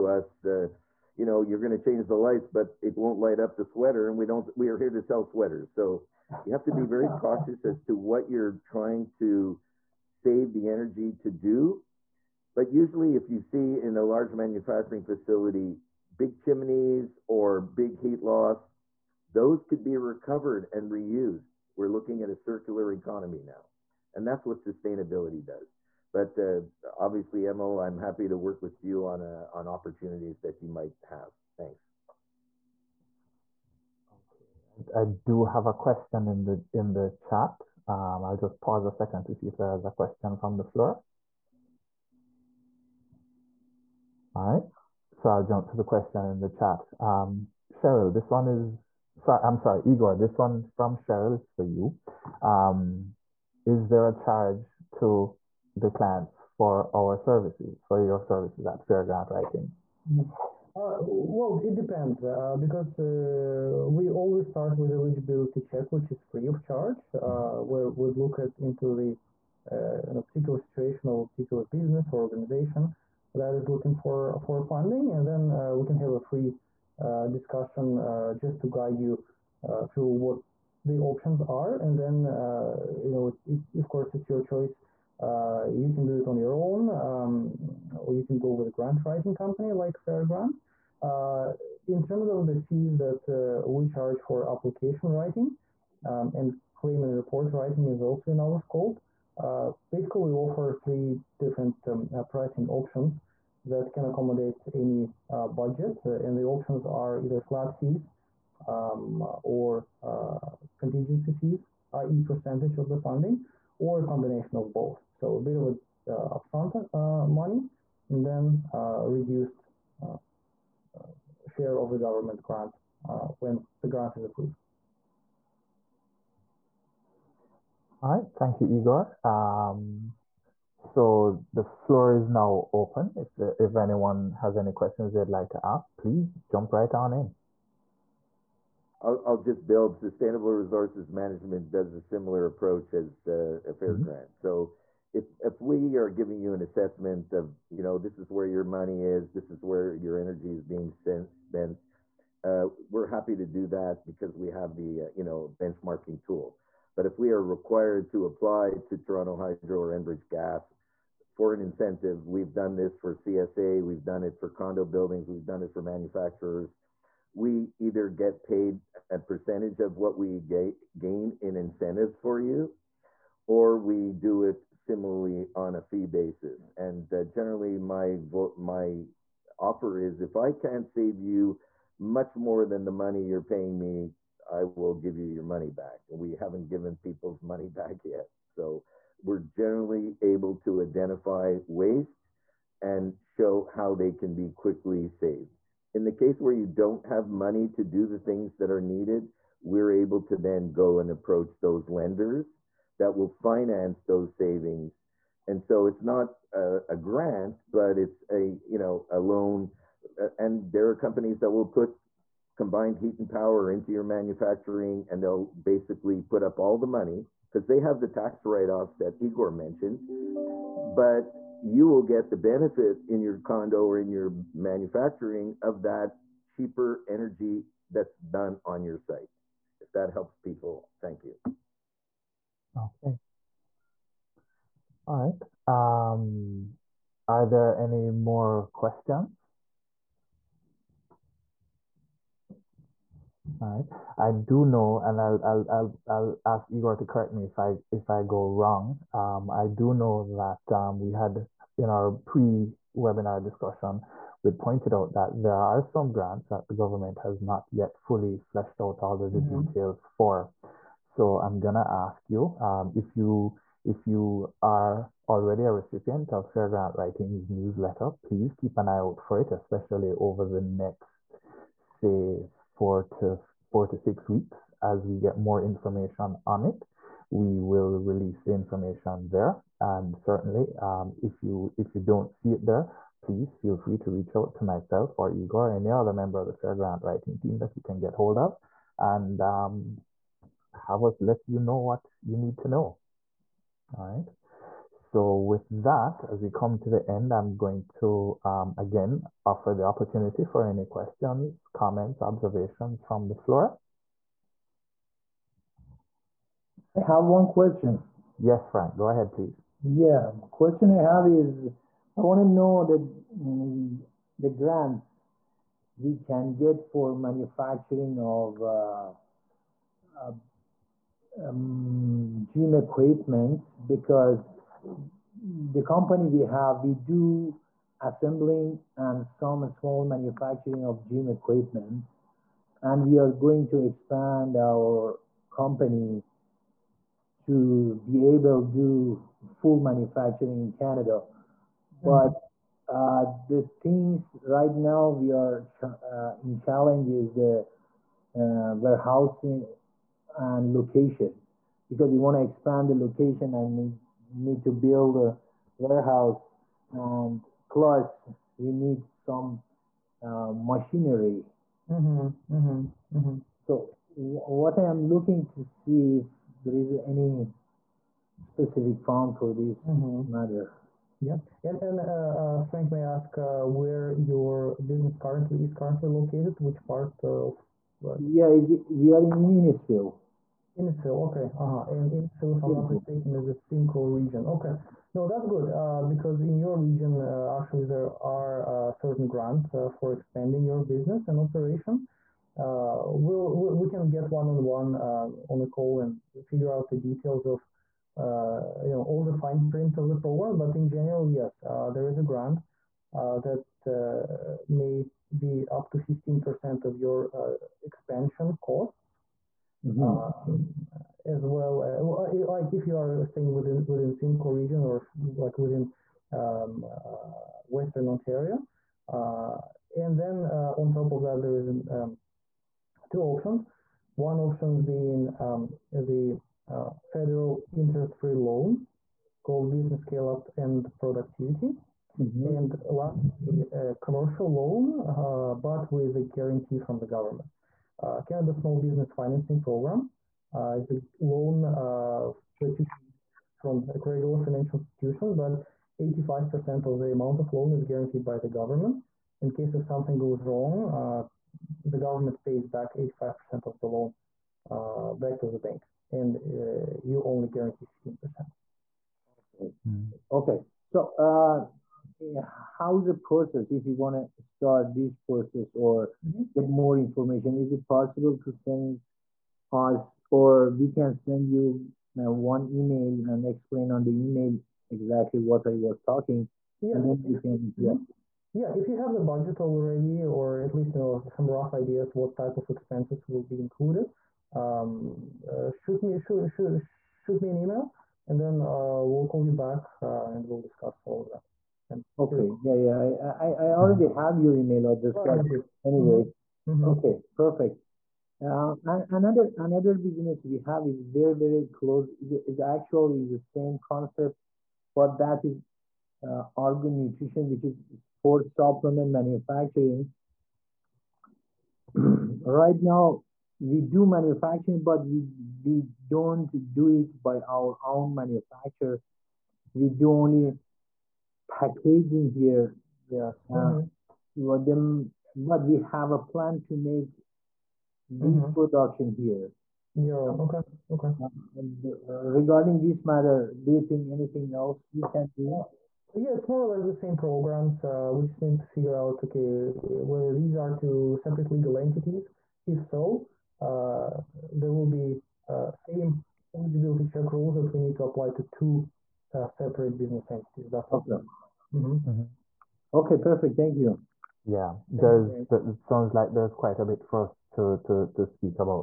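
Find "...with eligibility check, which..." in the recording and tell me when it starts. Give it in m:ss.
1:04.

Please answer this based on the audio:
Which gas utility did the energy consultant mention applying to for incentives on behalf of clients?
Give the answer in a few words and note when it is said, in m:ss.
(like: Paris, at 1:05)
Enbridge Gas, at 2:39.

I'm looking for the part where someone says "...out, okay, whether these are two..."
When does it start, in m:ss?
8:59.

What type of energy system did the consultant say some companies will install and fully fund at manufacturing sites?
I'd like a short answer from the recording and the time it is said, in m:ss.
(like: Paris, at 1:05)
combined heat and power, at 3:32.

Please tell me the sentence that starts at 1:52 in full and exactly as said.
percentage of the funding, or a combination of both.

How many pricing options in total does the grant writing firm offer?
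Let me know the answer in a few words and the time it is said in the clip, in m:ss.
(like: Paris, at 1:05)
3, at 1:40.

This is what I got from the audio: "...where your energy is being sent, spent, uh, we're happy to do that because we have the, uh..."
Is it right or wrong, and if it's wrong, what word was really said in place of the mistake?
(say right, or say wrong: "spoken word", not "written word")
right.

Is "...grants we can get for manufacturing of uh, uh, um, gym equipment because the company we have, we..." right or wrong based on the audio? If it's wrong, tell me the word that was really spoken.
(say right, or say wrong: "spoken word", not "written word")
right.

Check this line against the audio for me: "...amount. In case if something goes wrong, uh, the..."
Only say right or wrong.
wrong.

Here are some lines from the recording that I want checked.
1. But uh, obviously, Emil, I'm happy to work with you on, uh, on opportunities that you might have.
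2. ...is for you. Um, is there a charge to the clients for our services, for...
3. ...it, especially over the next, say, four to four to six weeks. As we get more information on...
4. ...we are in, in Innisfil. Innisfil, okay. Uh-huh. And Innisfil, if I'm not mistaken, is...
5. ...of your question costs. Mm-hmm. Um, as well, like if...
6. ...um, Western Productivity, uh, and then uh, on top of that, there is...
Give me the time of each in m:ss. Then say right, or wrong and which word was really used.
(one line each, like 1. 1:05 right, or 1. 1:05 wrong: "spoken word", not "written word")
1. 0:26 right
2. 0:51 right
3. 4:29 right
4. 6:18 right
5. 6:46 wrong: "expansion", not "question"
6. 6:56 wrong: "Ontario", not "Productivity".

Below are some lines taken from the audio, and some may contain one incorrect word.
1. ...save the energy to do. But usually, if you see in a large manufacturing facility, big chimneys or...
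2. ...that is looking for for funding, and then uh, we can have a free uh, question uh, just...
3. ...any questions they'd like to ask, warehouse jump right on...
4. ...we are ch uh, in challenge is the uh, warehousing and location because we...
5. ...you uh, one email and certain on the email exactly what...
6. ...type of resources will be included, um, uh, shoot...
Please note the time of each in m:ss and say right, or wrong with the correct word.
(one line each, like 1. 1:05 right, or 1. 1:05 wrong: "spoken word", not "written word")
1. 0:10 right
2. 1:13 wrong: "discussion", not "question"
3. 2:14 wrong: "please", not "warehouse"
4. 5:45 right
5. 7:51 wrong: "explain", not "certain"
6. 8:02 wrong: "expenses", not "resources".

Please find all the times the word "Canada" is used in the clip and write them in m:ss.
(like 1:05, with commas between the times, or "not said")
5:40, 7:18.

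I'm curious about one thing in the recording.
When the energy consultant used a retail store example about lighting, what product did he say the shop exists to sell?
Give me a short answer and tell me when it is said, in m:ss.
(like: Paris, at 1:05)
sweaters, at 0:04.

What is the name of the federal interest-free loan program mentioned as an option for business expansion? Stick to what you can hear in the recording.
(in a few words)
Business Scale-Up and Productivity.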